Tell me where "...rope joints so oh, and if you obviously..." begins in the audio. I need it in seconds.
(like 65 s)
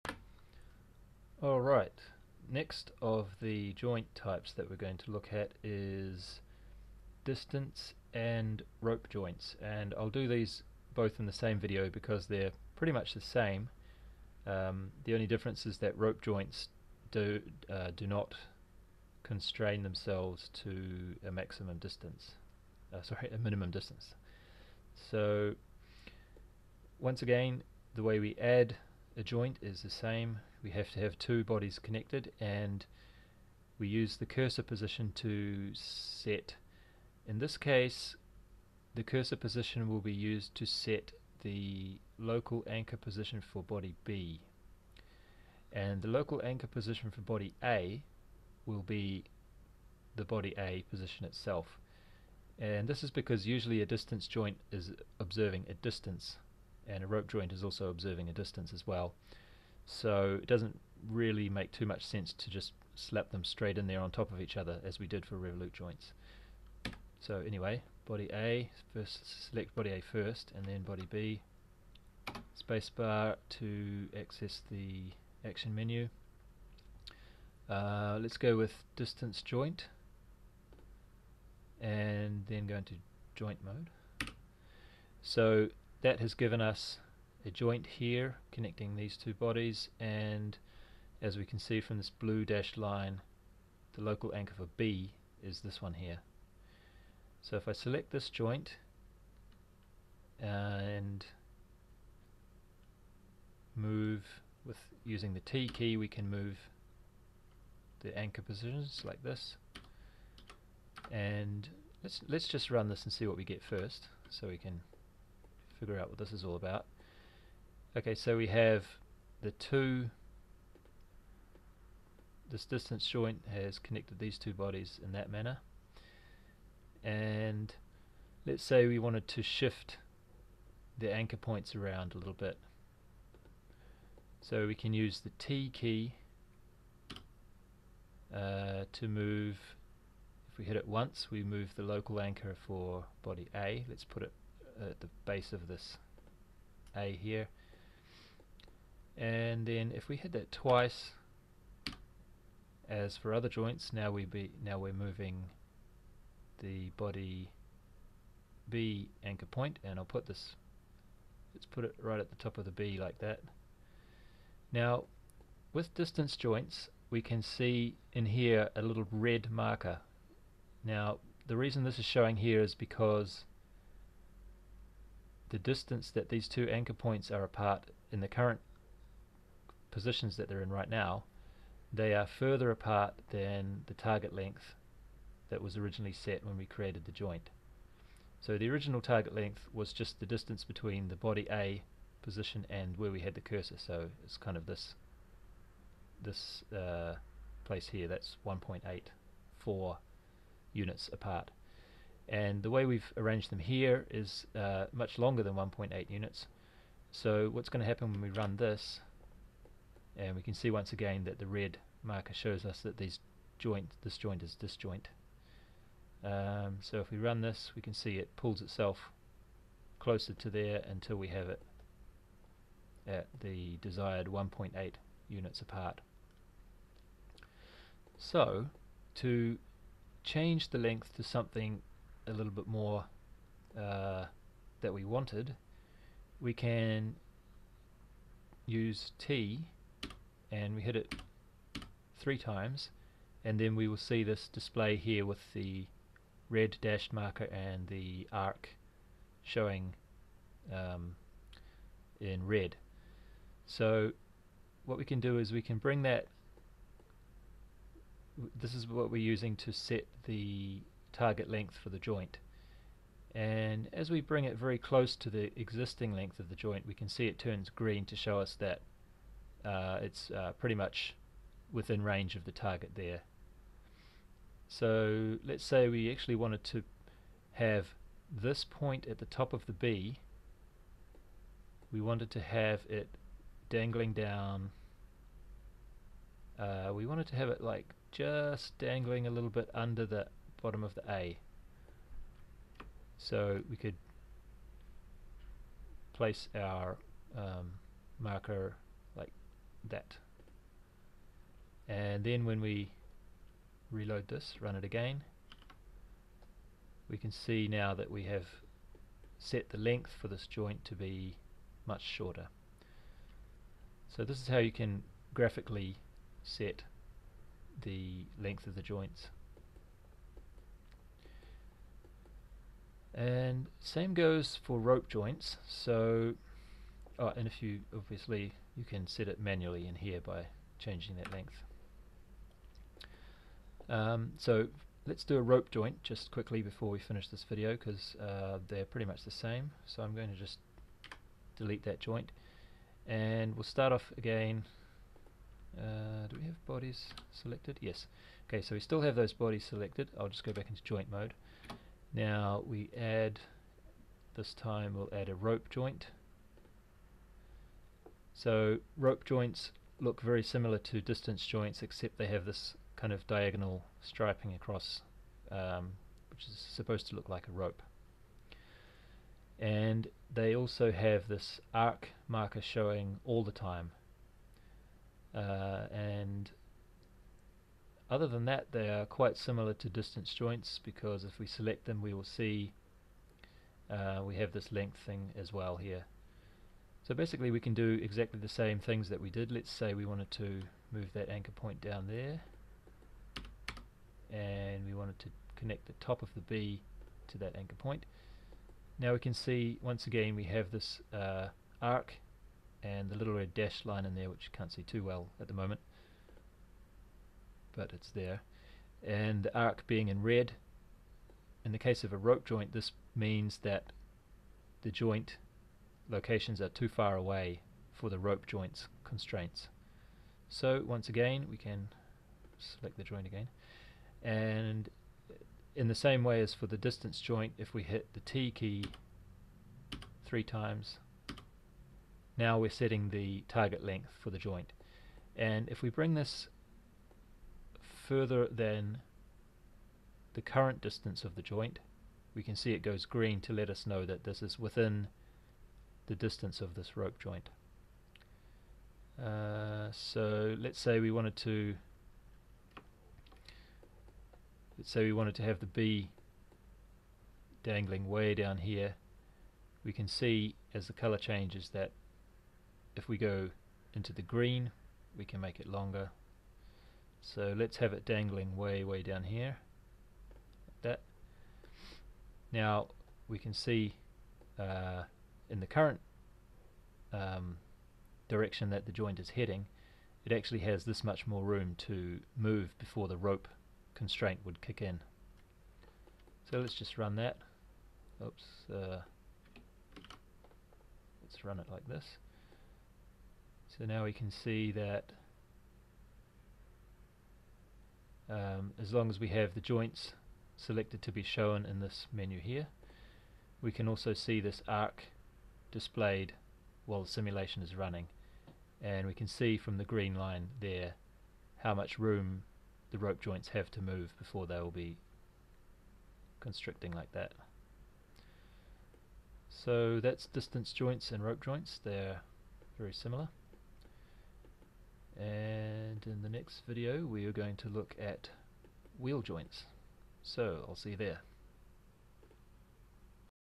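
324 s.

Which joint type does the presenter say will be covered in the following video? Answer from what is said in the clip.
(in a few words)
Wheel joints.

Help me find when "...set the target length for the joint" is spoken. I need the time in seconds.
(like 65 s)
259 s.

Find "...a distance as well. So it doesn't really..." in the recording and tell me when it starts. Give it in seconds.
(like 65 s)
58 s.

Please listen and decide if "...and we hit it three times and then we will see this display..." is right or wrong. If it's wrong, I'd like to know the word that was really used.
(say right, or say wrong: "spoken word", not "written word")
right.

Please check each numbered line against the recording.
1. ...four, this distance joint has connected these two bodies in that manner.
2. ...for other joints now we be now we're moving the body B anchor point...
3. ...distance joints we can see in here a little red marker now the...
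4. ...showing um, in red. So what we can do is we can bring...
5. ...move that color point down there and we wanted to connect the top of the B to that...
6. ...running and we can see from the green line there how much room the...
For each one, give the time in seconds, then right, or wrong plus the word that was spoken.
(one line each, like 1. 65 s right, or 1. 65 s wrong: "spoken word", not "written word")
1. 119 s wrong: "two", not "four"
2. 153 s right
3. 165 s right
4. 249 s right
5. 390 s wrong: "anchor", not "color"
6. 507 s right.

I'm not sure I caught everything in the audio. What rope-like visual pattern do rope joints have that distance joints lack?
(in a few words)
Diagonal striping.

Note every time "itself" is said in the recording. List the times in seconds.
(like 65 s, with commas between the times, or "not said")
51 s, 218 s.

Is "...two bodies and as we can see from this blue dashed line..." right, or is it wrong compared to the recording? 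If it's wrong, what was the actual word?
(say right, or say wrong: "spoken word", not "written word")
right.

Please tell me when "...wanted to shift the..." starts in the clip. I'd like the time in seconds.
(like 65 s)
128 s.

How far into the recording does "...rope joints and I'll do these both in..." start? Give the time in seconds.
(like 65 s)
8 s.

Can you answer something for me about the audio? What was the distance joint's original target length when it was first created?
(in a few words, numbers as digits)
1.84.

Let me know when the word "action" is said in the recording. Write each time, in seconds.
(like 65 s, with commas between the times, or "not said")
75 s.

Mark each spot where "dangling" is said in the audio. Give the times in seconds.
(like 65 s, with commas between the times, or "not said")
283 s, 288 s, 457 s, 468 s.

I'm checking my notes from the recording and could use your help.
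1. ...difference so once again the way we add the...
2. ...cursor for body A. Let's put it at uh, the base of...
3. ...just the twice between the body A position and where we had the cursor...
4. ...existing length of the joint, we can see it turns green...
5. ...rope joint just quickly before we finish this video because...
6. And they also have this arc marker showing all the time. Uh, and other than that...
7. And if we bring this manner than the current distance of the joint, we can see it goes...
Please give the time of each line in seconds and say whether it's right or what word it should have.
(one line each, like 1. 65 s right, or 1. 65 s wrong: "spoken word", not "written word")
1. 23 s wrong: "distance", not "difference"
2. 142 s wrong: "anchor", not "cursor"
3. 189 s wrong: "distance", not "twice"
4. 265 s right
5. 335 s right
6. 369 s right
7. 435 s wrong: "further", not "manner".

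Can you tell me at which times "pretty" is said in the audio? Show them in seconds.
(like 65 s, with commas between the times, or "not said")
12 s, 270 s, 338 s.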